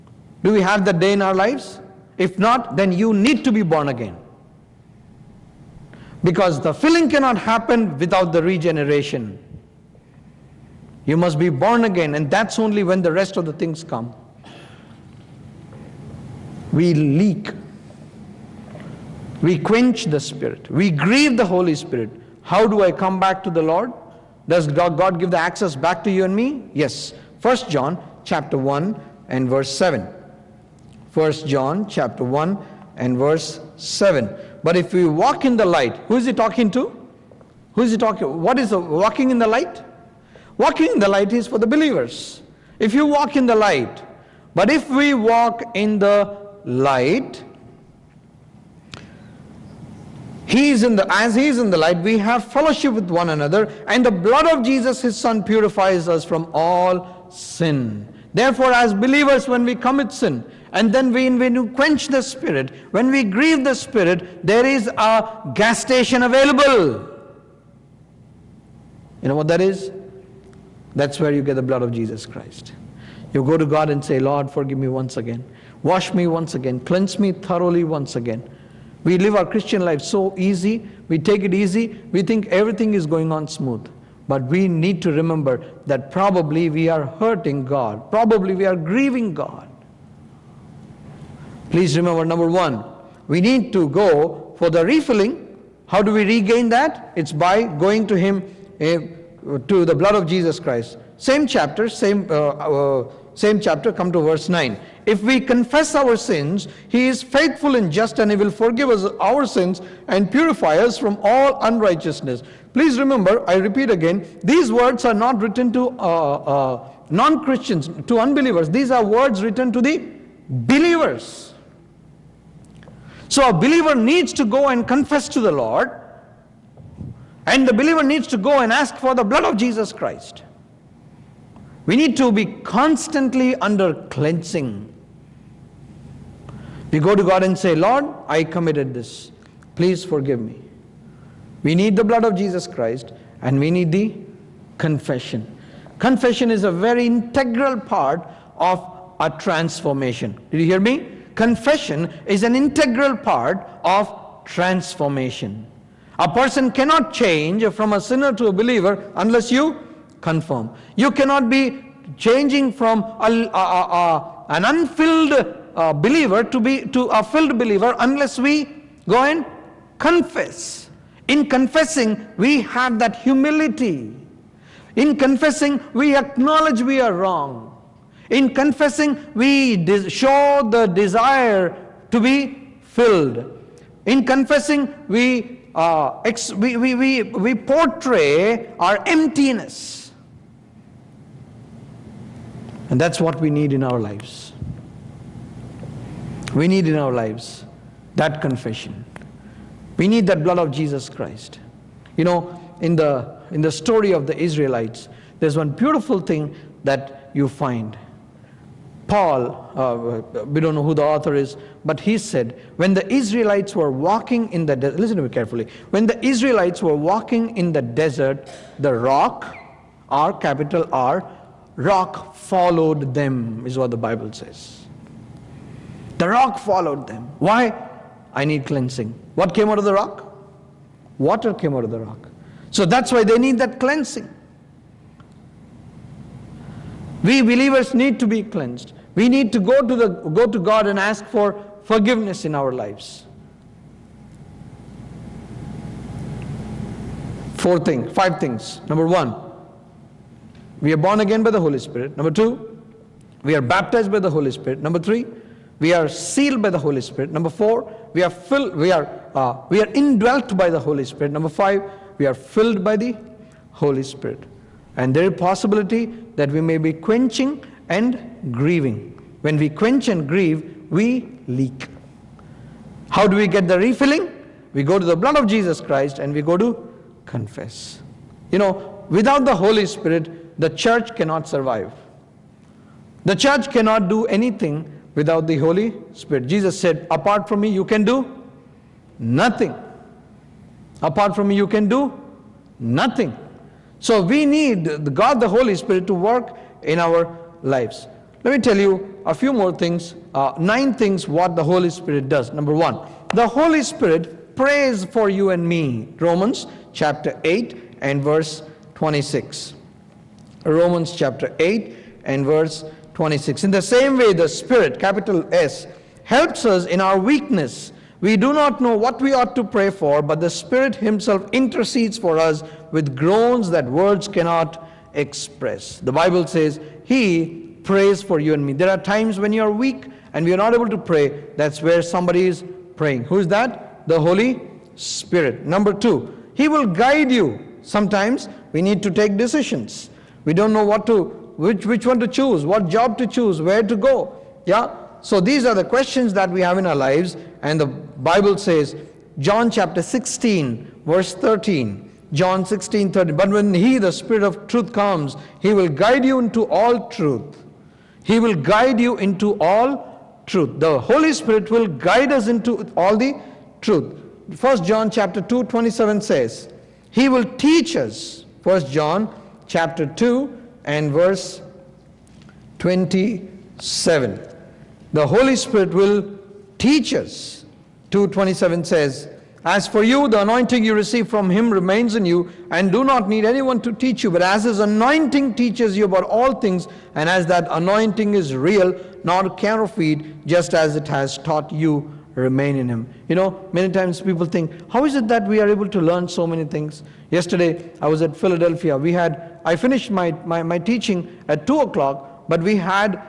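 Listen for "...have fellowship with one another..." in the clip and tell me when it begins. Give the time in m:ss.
0:52.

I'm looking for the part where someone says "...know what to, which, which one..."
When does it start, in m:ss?
5:40.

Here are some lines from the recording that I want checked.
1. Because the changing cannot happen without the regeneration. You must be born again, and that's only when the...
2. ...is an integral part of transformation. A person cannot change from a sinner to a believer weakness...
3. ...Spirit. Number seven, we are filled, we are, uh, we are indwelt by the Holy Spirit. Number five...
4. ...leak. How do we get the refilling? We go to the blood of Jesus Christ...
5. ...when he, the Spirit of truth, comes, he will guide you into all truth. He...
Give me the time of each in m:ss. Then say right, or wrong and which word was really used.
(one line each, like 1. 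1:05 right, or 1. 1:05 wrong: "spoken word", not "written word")
1. 0:06 wrong: "filling", not "changing"
2. 2:32 wrong: "unless", not "weakness"
3. 4:16 wrong: "four", not "seven"
4. 4:31 right
5. 5:53 right.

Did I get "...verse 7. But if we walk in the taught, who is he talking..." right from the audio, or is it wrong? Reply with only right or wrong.
wrong.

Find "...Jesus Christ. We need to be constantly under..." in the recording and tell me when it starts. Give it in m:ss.
2:09.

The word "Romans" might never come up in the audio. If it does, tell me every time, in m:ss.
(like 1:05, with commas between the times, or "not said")
5:06, 5:10.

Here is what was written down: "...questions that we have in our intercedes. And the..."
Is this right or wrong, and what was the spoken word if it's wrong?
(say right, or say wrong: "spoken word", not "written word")
wrong: "lives", not "intercedes".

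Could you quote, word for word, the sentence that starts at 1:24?
But we need to remember that probably we are hurting God, probably we are grieving God.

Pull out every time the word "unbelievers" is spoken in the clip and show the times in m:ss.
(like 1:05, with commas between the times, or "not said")
1:58.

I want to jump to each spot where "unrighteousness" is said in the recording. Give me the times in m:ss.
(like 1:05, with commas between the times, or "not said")
1:51.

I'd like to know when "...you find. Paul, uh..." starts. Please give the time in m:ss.
3:27.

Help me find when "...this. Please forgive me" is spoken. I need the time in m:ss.
2:18.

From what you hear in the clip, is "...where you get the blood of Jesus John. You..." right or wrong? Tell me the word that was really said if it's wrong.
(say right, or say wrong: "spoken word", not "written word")
wrong: "Christ", not "John".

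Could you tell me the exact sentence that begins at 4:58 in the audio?
Let me tell you a few more things, uh, nine things what the Holy Spirit does.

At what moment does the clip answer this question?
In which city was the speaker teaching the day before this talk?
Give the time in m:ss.
6:38.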